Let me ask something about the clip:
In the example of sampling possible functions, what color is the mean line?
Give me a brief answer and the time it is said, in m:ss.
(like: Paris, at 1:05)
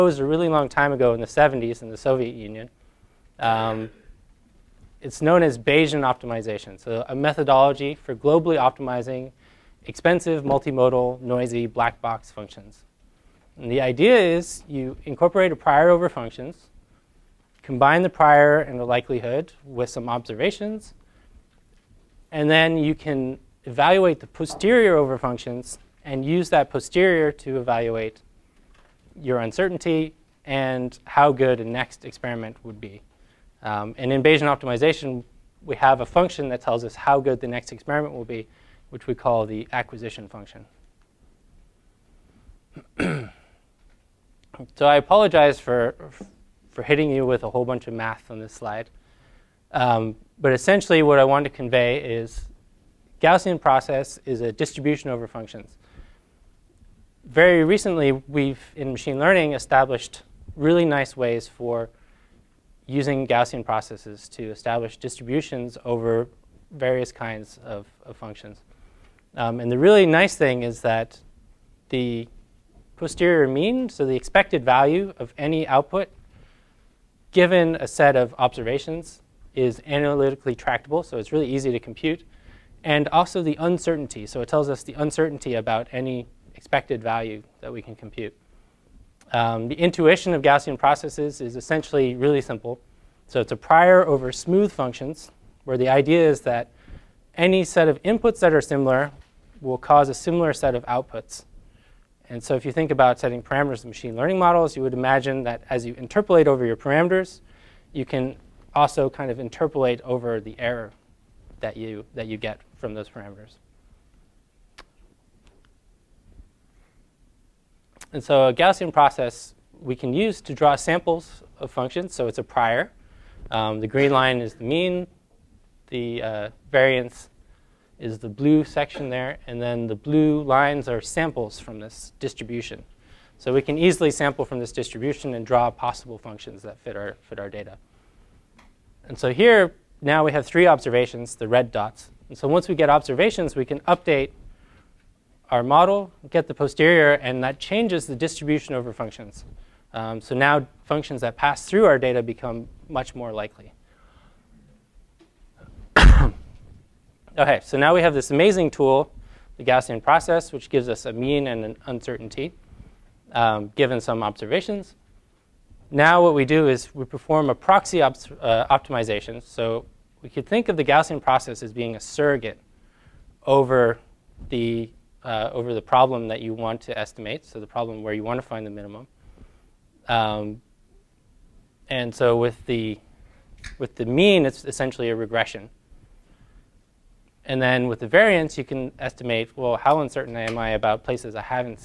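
green, at 2:03.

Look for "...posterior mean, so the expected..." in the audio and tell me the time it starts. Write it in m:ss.
1:12.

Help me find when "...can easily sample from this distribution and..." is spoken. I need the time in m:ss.
2:13.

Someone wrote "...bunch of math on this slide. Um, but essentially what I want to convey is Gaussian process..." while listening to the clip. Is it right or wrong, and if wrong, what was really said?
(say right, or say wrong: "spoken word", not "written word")
right.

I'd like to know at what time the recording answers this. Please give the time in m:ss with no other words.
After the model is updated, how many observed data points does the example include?
2:20.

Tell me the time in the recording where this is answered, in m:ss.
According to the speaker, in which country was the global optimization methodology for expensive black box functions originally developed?
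0:01.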